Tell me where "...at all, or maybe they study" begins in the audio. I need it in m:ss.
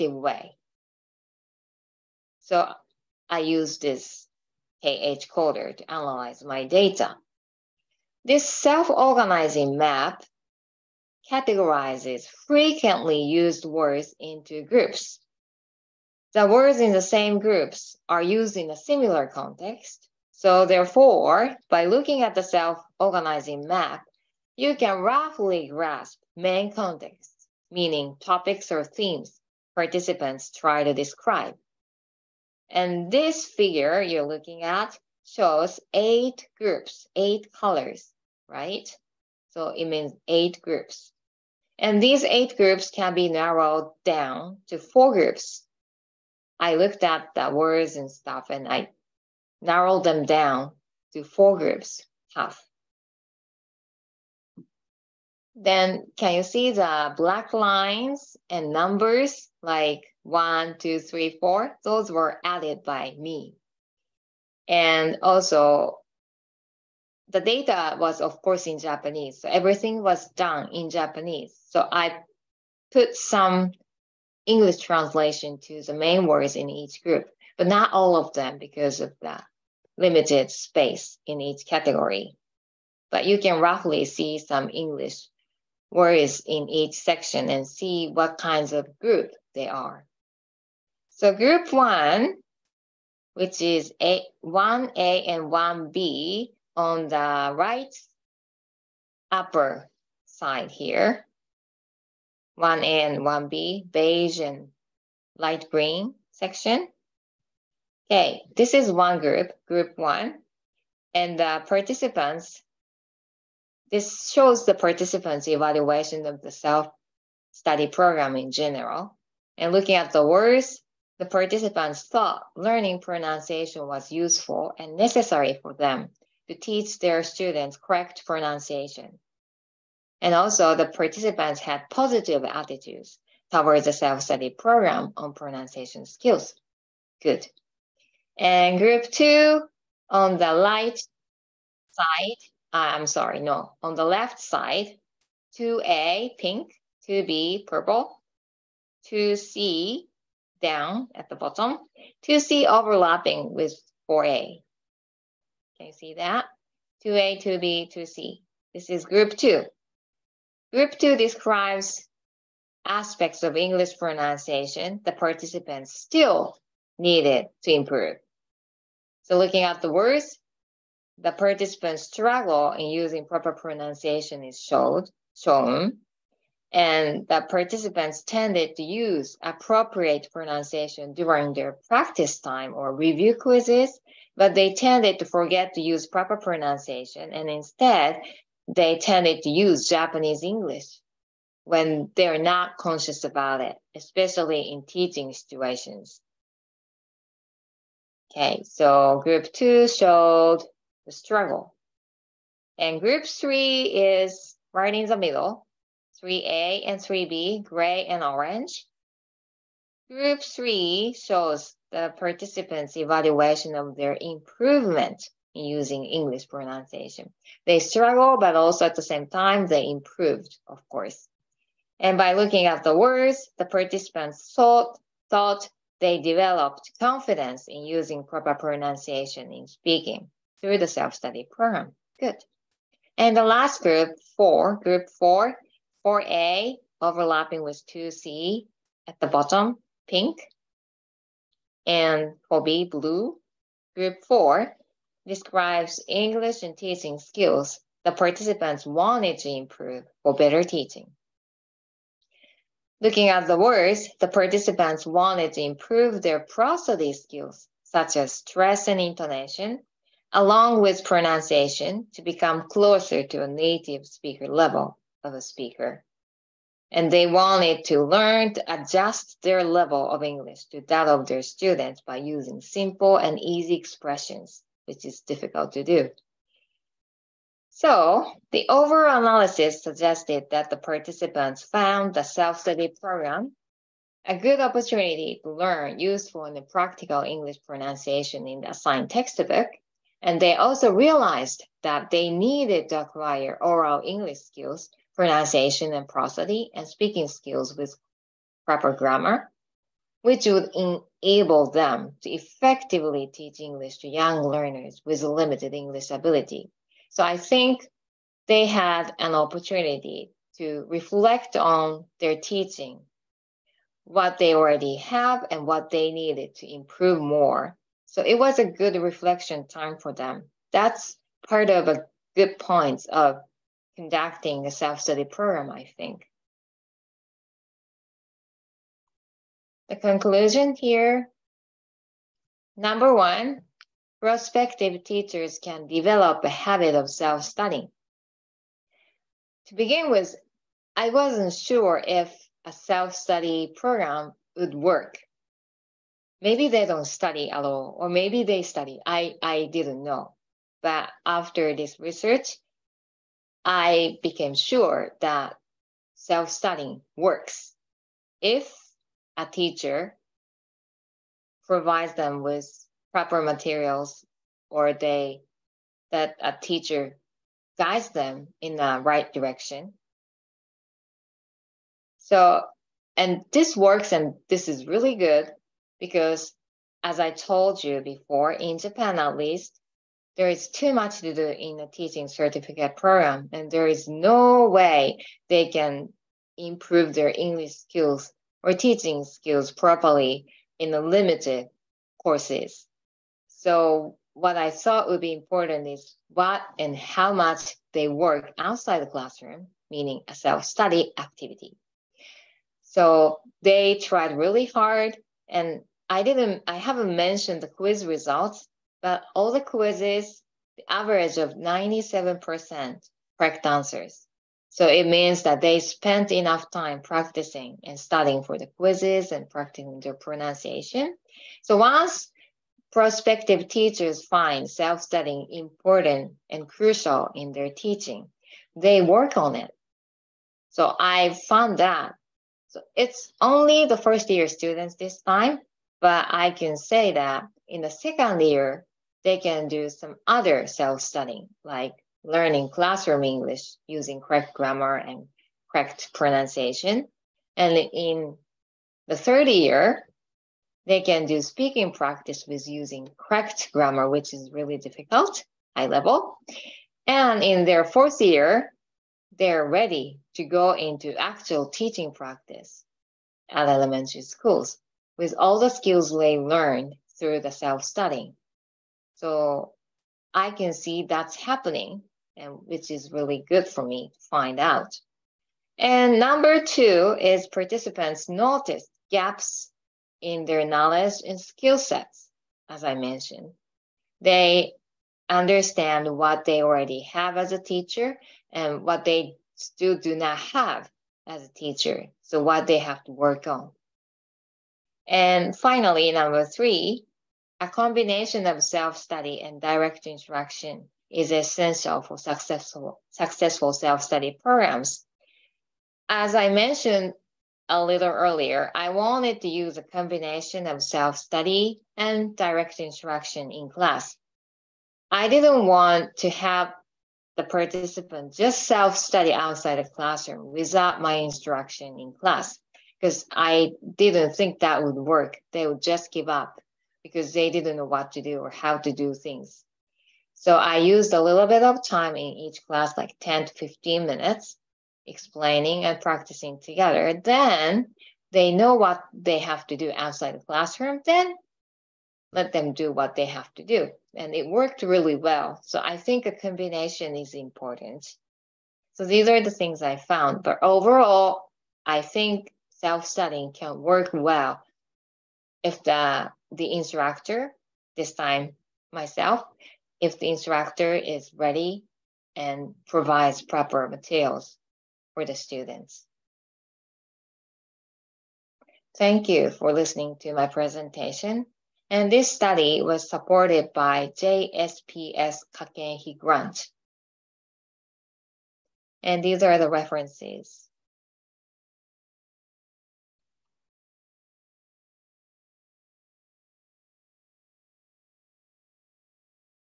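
5:47.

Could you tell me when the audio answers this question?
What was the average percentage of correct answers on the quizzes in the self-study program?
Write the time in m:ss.
6:51.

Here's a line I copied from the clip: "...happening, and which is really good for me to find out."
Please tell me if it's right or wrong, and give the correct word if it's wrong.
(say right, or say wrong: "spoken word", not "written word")
right.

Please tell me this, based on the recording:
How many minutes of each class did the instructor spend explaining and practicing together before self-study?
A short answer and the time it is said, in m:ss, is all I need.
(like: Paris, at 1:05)
10 to 15 minutes, at 8:53.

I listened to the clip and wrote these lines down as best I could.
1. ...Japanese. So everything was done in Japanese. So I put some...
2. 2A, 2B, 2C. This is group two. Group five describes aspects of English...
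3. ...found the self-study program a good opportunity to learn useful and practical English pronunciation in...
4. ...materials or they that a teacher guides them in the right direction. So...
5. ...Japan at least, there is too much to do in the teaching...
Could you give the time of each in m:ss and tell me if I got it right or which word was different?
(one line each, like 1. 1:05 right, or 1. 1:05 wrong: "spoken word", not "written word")
1. 1:08 right
2. 2:37 wrong: "two", not "five"
3. 4:41 right
4. 6:03 right
5. 6:18 right.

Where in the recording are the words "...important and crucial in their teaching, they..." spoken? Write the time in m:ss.
7:05.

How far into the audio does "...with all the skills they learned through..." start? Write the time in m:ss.
7:45.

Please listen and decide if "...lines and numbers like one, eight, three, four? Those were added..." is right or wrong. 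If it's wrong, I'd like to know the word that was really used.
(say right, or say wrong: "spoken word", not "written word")
wrong: "two", not "eight".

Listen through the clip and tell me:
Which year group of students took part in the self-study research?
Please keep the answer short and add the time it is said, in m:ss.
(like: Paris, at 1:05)
first year, at 7:13.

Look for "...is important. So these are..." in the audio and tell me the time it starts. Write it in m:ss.
9:07.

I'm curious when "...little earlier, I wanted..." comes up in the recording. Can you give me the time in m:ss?
8:27.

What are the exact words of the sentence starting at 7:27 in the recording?
And in the third year, they can do speaking practice with using correct grammar, which is really difficult, high level.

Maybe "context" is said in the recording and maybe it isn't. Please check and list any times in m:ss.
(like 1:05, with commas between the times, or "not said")
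0:19, 0:26.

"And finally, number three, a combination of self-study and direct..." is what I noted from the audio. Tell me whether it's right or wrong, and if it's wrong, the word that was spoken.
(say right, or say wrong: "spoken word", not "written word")
right.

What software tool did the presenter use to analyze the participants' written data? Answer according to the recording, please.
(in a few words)
KH coder.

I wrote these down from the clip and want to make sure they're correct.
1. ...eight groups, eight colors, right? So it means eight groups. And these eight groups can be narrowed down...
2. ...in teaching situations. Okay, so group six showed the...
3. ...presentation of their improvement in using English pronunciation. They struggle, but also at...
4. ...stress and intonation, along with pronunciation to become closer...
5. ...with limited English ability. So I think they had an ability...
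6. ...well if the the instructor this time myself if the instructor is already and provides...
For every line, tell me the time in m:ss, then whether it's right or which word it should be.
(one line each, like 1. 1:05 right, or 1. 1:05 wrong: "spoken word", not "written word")
1. 0:35 right
2. 3:14 wrong: "two", not "six"
3. 3:32 wrong: "evaluation", not "presentation"
4. 4:18 right
5. 5:05 wrong: "opportunity", not "ability"
6. 9:14 wrong: "ready", not "already".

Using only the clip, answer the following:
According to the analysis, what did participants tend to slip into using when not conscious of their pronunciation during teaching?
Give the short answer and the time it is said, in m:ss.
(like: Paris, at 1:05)
Japanese English, at 3:09.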